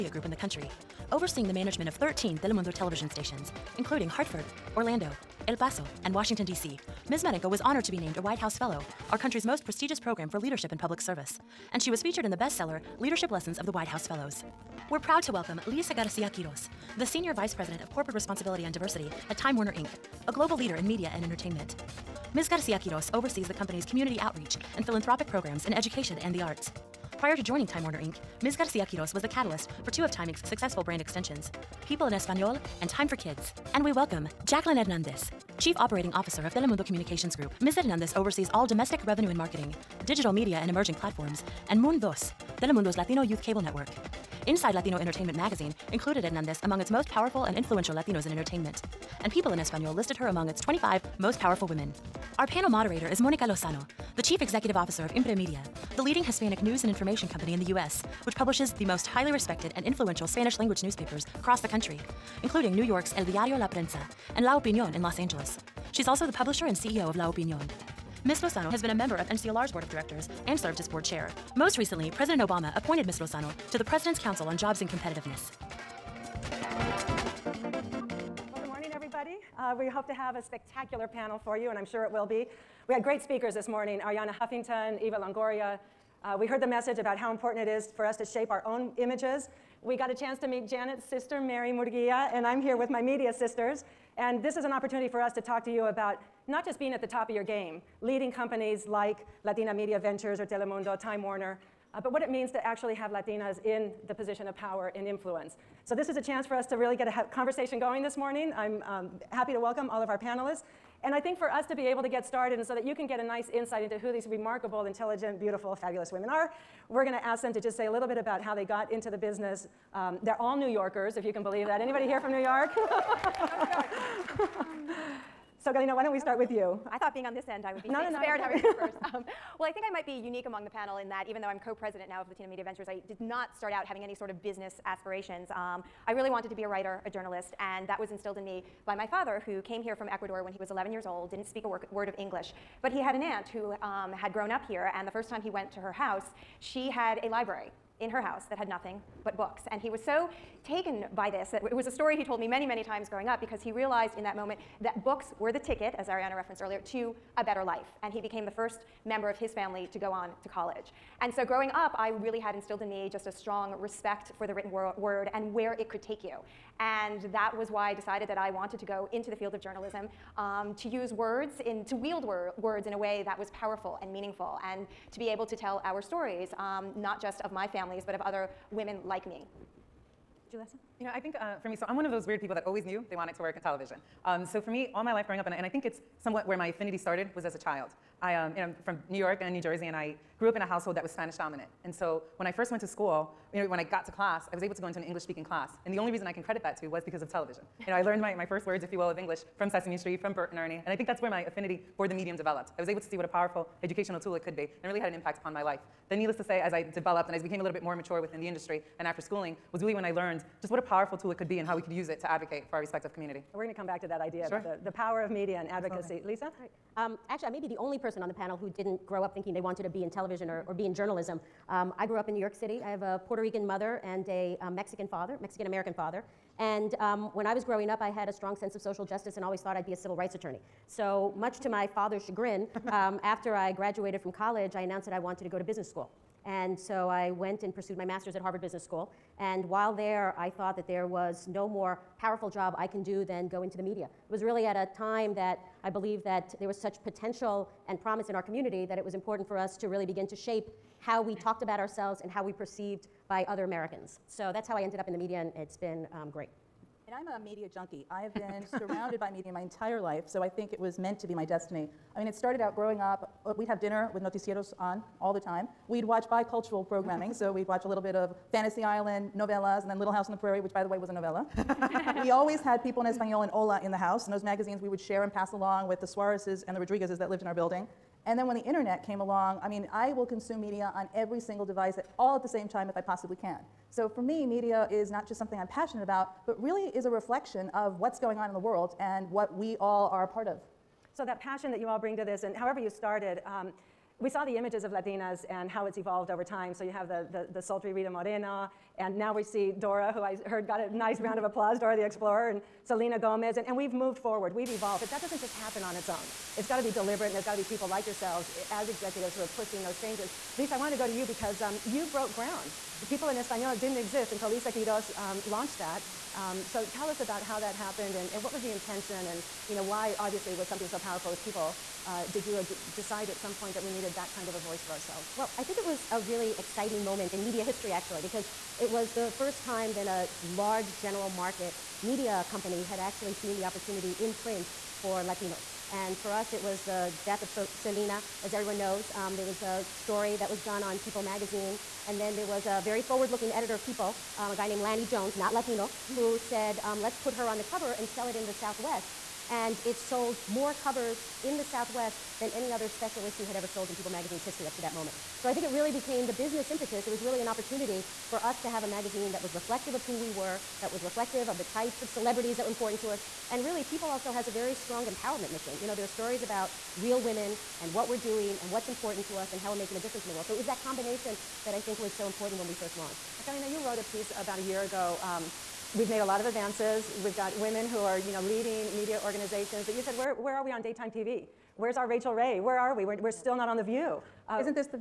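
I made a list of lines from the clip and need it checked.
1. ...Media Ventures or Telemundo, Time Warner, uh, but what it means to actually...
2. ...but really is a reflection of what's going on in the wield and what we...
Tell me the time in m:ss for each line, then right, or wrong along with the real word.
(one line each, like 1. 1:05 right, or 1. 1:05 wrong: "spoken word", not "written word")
1. 1:39 right
2. 4:46 wrong: "world", not "wield".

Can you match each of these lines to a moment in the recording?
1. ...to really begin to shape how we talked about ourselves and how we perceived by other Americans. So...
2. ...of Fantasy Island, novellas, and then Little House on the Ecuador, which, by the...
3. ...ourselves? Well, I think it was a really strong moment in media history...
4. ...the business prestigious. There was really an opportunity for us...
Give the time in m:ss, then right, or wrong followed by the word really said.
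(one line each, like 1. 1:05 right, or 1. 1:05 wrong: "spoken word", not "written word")
1. 4:09 right
2. 4:28 wrong: "Prairie", not "Ecuador"
3. 5:24 wrong: "exciting", not "strong"
4. 5:56 wrong: "impetus", not "prestigious".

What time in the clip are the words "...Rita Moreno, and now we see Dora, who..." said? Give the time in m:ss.
4:57.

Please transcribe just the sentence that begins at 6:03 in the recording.
And really, People also has a very strong empowerment mission.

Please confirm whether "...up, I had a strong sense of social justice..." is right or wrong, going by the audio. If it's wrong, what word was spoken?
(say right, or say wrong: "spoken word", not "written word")
right.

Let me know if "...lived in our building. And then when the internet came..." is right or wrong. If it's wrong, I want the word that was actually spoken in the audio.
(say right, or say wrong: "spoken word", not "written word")
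right.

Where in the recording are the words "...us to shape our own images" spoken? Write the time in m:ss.
1:28.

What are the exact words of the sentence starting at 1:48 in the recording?
I'm um, happy to welcome all of our panelists.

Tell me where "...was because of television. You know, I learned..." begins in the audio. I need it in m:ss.
3:16.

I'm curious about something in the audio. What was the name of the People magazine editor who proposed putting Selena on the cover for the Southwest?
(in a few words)
Lanny Jones.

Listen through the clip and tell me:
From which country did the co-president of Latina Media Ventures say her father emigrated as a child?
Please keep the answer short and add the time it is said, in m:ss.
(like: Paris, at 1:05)
Ecuador, at 2:20.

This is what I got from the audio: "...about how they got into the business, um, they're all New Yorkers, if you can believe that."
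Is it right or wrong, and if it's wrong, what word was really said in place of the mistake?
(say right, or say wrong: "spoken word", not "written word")
right.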